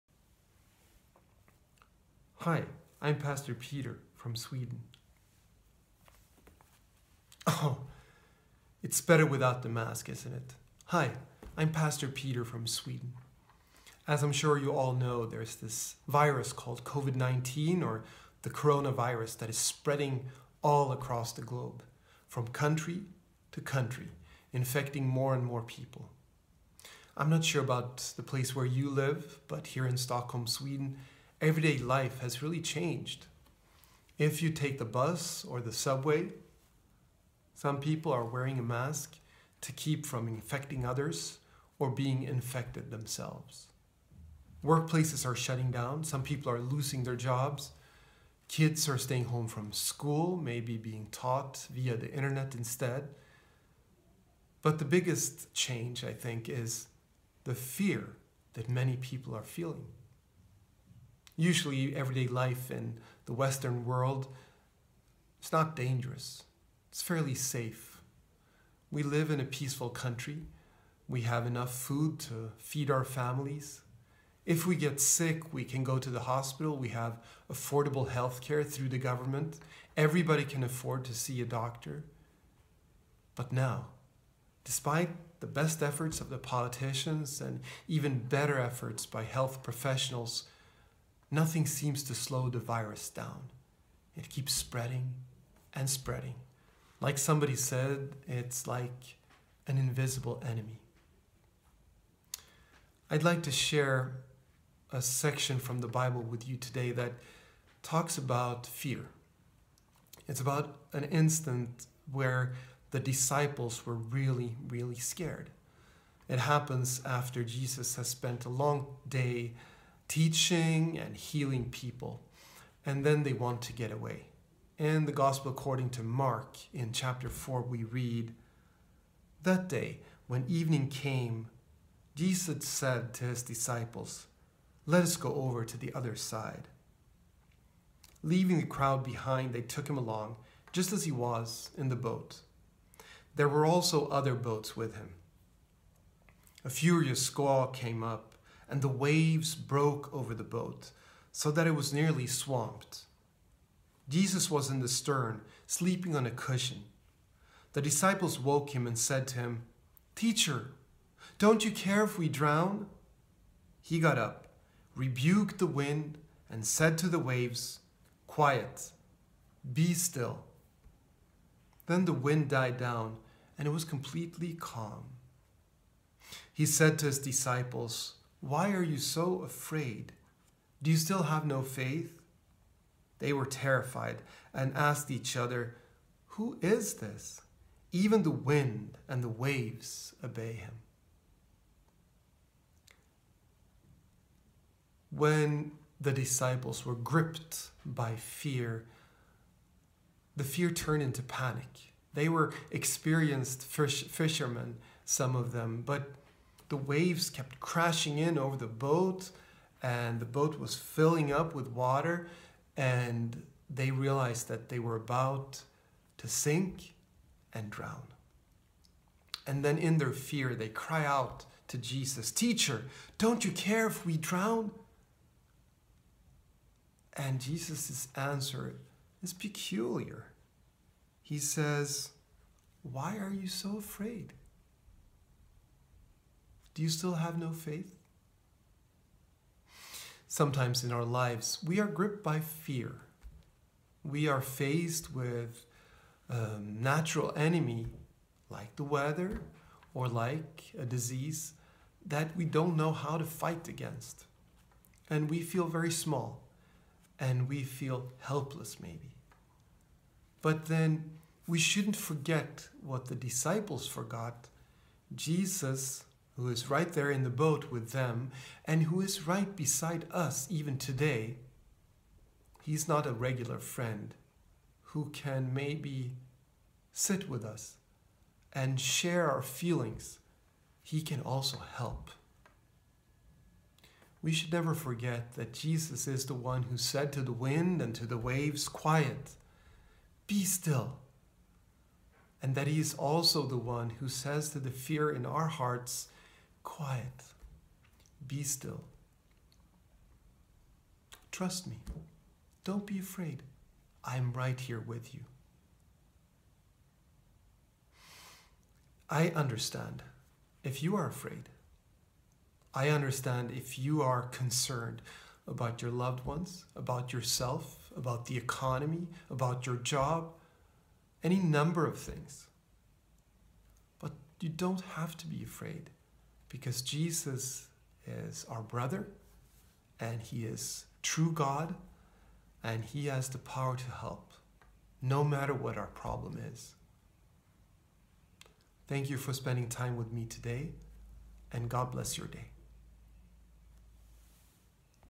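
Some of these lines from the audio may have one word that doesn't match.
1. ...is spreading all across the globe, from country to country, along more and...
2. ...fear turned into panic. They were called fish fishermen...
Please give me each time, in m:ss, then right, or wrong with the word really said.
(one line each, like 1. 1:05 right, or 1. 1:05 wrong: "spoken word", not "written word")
1. 0:19 wrong: "infecting", not "along"
2. 3:20 wrong: "experienced", not "called".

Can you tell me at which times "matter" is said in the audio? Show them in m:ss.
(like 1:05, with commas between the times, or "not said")
5:35.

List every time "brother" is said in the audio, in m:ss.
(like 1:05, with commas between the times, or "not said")
5:28.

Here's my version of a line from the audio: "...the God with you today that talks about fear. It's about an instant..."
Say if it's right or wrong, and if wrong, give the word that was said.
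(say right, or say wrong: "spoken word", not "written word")
wrong: "Bible", not "God".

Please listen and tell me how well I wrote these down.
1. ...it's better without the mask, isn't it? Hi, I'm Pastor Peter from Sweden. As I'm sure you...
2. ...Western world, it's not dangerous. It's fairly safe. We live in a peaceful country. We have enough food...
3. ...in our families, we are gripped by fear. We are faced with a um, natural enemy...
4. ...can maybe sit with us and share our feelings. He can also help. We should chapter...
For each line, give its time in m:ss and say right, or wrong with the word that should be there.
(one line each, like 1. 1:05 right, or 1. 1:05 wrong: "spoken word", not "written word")
1. 0:08 right
2. 1:03 right
3. 4:00 wrong: "lives", not "families"
4. 4:35 wrong: "never", not "chapter".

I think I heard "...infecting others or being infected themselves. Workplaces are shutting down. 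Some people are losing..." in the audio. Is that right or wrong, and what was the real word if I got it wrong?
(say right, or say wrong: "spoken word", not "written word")
right.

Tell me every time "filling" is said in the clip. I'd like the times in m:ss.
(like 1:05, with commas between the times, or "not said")
3:30.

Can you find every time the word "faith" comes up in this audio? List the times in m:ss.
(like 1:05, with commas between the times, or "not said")
3:01, 3:57.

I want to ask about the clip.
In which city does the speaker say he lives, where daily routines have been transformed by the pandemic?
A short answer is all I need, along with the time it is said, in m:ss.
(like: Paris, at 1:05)
Stockholm, at 0:29.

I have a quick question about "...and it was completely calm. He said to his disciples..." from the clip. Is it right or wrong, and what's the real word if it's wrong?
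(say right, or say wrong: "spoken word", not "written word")
right.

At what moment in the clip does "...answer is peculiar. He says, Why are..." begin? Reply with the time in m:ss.
3:48.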